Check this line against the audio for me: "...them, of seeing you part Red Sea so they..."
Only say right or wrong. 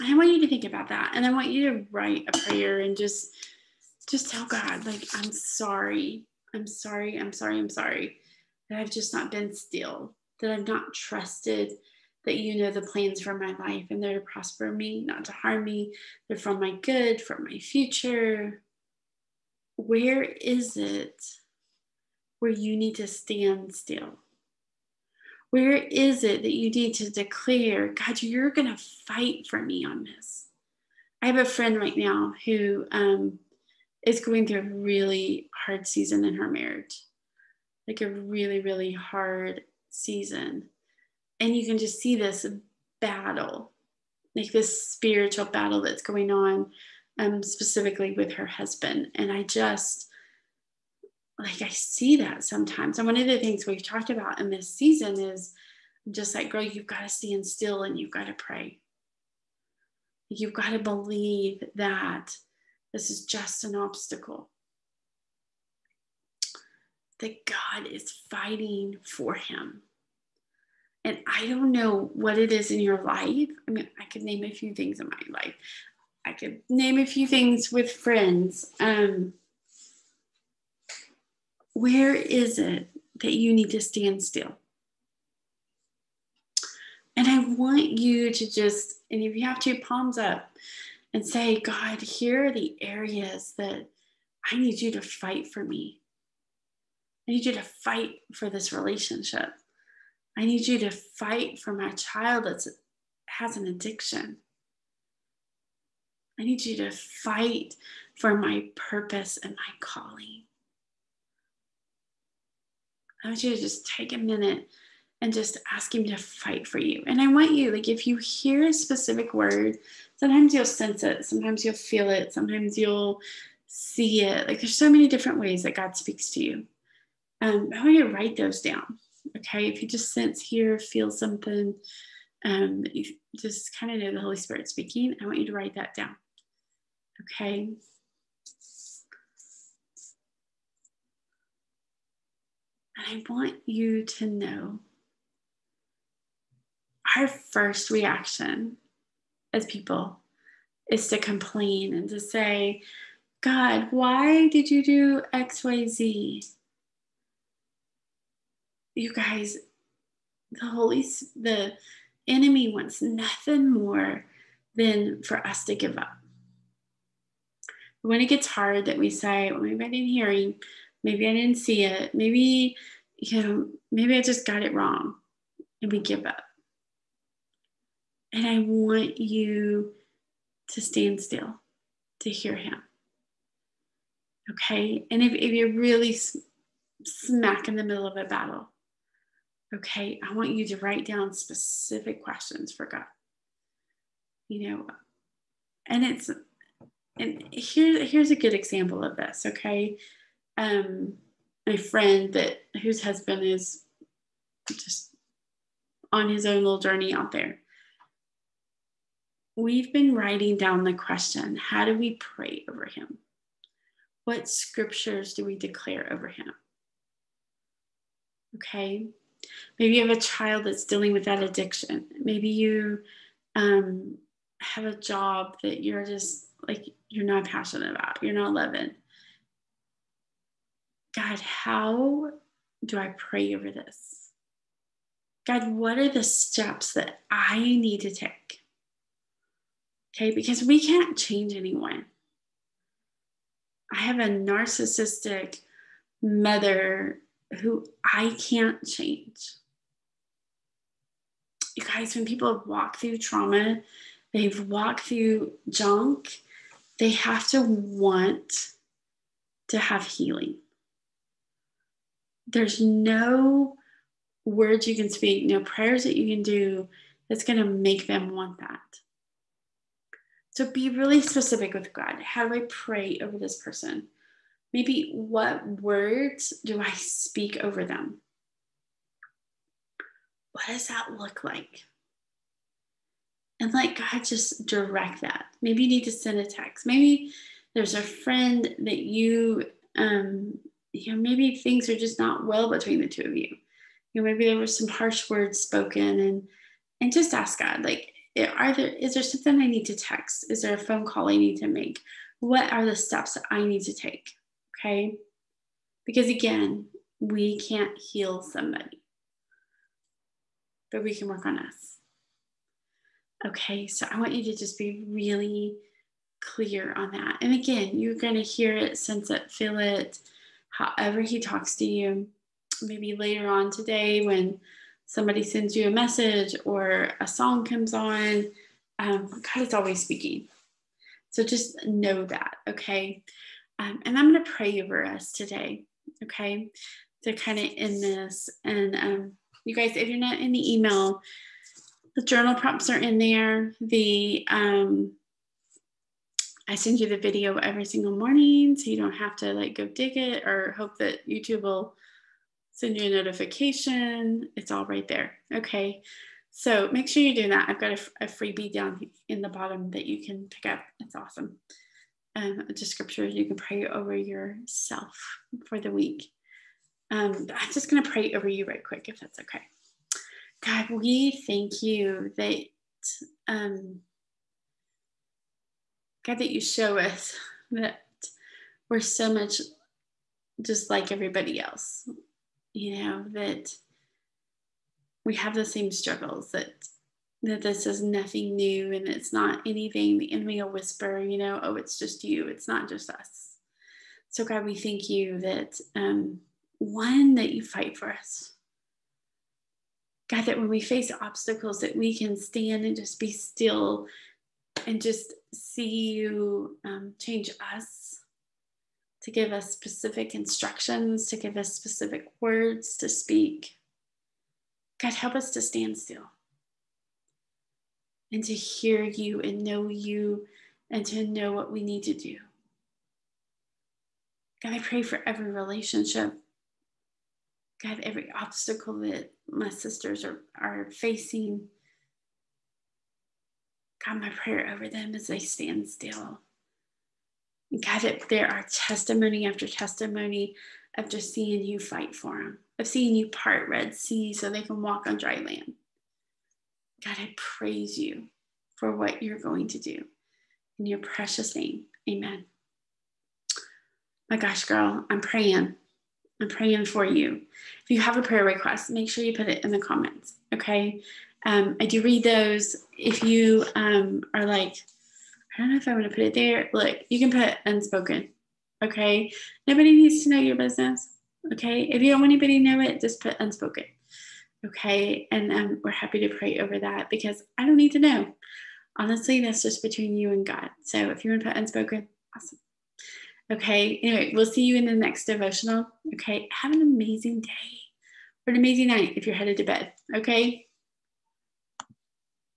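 right.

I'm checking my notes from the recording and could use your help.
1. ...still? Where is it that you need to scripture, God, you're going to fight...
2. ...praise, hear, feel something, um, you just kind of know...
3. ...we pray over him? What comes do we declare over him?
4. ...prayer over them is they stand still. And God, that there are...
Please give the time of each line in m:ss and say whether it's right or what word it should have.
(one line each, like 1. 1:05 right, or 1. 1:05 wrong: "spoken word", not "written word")
1. 0:23 wrong: "declare", not "scripture"
2. 2:10 wrong: "sense", not "praise"
3. 3:31 wrong: "scriptures", not "comes"
4. 7:14 right.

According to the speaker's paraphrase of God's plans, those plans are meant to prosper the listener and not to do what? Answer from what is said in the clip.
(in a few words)
harm me.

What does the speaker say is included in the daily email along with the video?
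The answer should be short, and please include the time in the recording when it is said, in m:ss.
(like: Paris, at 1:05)
journal prompts, at 5:42.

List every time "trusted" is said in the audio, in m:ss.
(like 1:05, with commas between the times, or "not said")
0:10.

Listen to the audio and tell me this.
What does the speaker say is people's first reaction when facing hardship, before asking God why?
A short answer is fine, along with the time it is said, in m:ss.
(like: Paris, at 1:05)
to complain, at 2:31.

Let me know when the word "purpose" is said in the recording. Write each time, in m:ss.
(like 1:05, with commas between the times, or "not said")
1:48.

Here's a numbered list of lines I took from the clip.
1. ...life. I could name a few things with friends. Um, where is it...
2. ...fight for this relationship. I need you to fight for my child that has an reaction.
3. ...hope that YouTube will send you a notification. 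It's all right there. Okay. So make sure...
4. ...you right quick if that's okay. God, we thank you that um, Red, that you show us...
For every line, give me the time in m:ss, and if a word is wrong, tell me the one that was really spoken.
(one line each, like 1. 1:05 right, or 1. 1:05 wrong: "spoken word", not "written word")
1. 1:15 right
2. 1:37 wrong: "addiction", not "reaction"
3. 5:50 right
4. 6:08 wrong: "God", not "Red".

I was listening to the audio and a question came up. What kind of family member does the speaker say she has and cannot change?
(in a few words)
narcissistic mother.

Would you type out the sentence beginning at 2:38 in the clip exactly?
You guys, the Holy, the enemy wants nothing more than for us to give up.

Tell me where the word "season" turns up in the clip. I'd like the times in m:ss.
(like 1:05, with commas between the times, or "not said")
0:35, 0:39, 0:54.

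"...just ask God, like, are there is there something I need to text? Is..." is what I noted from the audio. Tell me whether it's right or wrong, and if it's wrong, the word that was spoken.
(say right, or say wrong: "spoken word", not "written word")
right.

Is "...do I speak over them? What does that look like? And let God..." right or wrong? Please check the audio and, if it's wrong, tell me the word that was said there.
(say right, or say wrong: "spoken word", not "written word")
right.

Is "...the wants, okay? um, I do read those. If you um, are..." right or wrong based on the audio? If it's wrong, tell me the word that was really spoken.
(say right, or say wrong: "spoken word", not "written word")
wrong: "comments", not "wants".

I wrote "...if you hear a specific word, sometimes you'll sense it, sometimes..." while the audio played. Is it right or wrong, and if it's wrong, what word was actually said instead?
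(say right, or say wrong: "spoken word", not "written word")
right.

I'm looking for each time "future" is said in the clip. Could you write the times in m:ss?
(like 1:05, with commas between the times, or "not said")
0:17.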